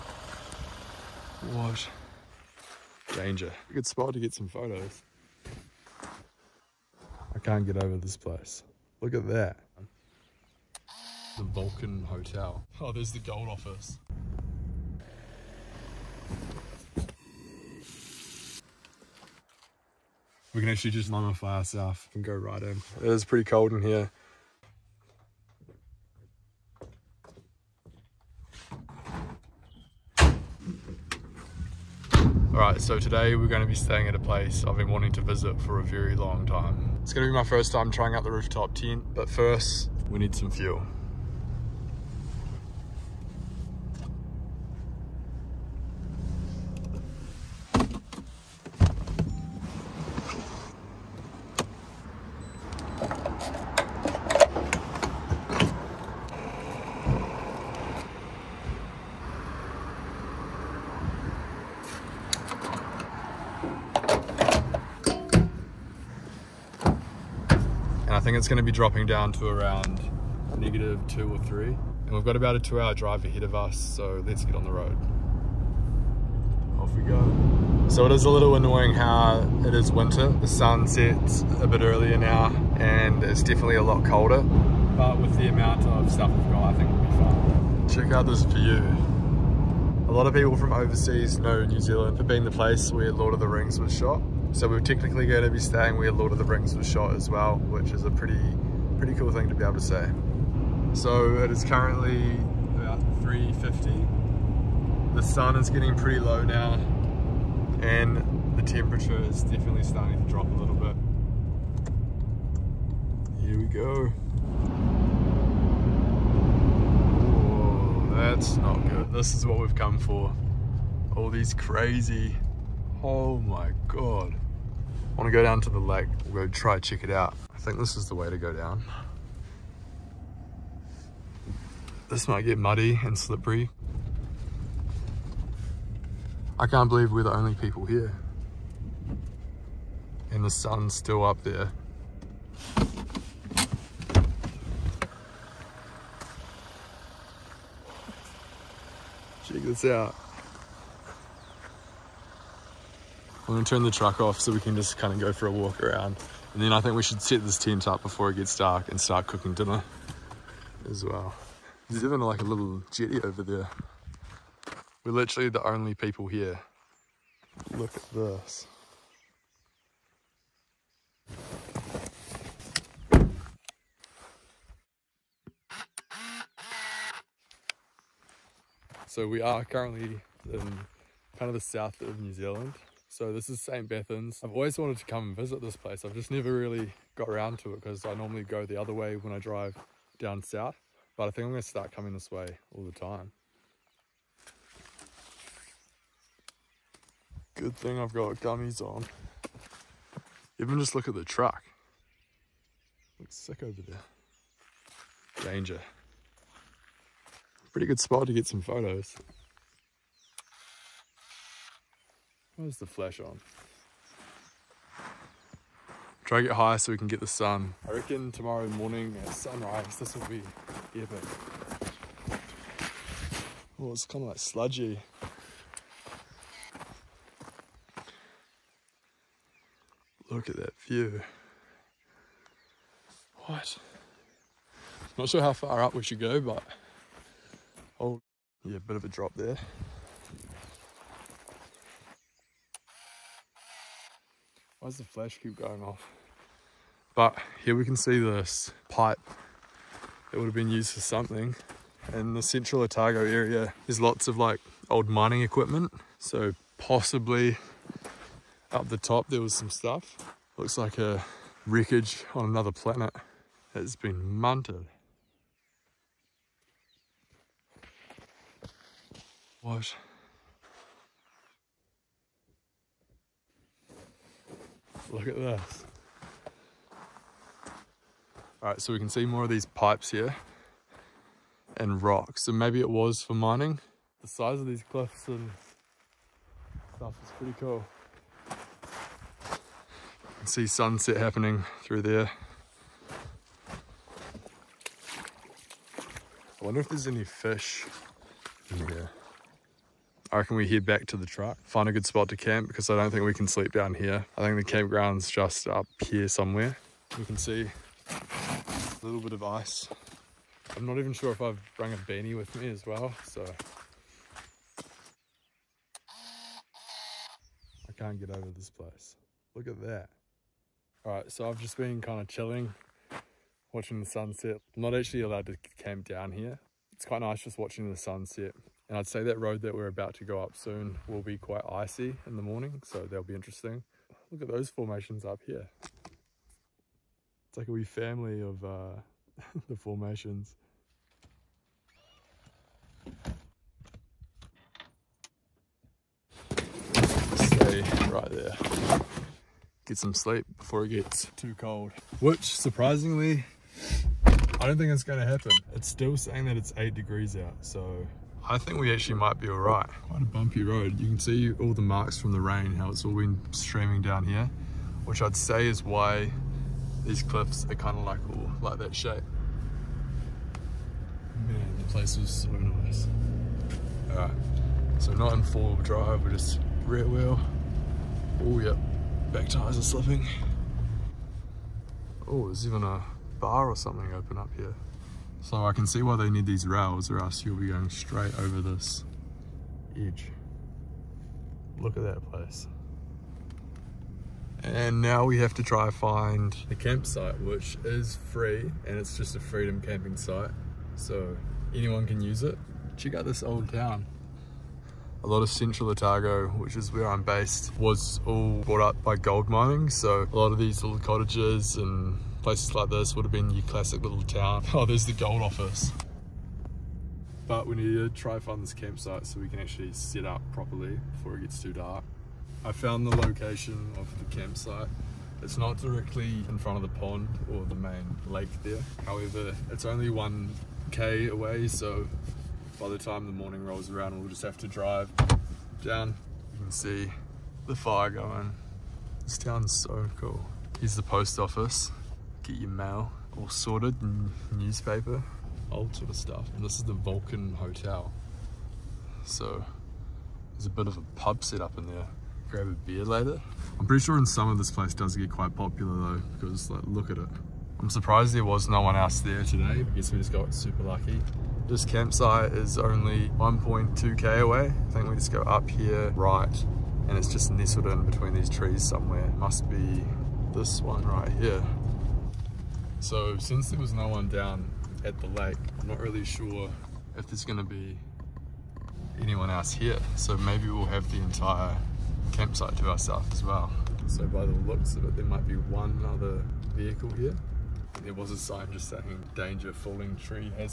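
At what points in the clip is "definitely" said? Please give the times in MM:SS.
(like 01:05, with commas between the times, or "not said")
01:23, 01:49.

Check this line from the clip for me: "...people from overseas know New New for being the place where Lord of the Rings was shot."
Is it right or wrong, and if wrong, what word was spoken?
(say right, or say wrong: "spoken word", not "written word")
wrong: "Zealand", not "New".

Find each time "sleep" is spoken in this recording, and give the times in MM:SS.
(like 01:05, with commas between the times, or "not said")
05:03, 05:50.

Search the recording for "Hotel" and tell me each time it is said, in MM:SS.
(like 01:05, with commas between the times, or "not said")
00:12, 07:27.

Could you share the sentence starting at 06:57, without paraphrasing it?
But we need to try find this campsite so we can actually set up properly before it gets too dark.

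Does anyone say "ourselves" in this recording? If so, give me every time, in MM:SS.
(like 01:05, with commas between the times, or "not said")
00:21, 08:02.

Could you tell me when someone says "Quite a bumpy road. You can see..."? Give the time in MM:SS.
06:00.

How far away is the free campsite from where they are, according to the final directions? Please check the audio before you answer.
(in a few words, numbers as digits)
1.2 km.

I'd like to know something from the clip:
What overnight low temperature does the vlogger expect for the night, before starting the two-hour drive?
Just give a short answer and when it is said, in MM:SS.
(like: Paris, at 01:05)
-2 or -3, at 01:10.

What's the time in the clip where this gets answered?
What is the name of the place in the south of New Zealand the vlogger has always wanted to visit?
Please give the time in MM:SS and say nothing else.
03:03.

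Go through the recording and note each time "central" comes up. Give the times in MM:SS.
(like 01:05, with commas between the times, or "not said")
04:12, 06:45.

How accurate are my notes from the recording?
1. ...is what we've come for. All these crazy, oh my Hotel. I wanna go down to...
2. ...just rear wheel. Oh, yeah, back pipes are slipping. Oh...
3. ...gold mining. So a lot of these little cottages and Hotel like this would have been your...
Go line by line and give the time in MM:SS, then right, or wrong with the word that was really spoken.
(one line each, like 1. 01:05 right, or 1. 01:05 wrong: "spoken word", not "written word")
1. 01:59 wrong: "God", not "Hotel"
2. 06:16 wrong: "tires", not "pipes"
3. 06:49 wrong: "Places", not "Hotel".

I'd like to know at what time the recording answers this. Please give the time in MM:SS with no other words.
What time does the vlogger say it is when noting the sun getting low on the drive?
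01:43.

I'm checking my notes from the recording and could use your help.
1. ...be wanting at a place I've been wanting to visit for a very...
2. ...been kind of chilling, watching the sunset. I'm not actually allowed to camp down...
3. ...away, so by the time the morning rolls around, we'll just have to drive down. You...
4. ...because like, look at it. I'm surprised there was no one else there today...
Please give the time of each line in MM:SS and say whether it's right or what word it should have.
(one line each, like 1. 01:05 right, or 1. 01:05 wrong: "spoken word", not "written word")
1. 00:33 wrong: "staying", not "wanting"
2. 05:21 right
3. 07:11 right
4. 07:36 right.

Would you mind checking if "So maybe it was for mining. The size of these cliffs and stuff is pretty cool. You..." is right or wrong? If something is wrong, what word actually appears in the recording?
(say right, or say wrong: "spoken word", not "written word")
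right.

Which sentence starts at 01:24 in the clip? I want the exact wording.
But with the amount of stuff we've got, I think we'll be fine.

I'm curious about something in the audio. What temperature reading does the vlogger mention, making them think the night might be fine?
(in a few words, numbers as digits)
8 degrees.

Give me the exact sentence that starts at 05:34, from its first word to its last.
Look at those formations up here.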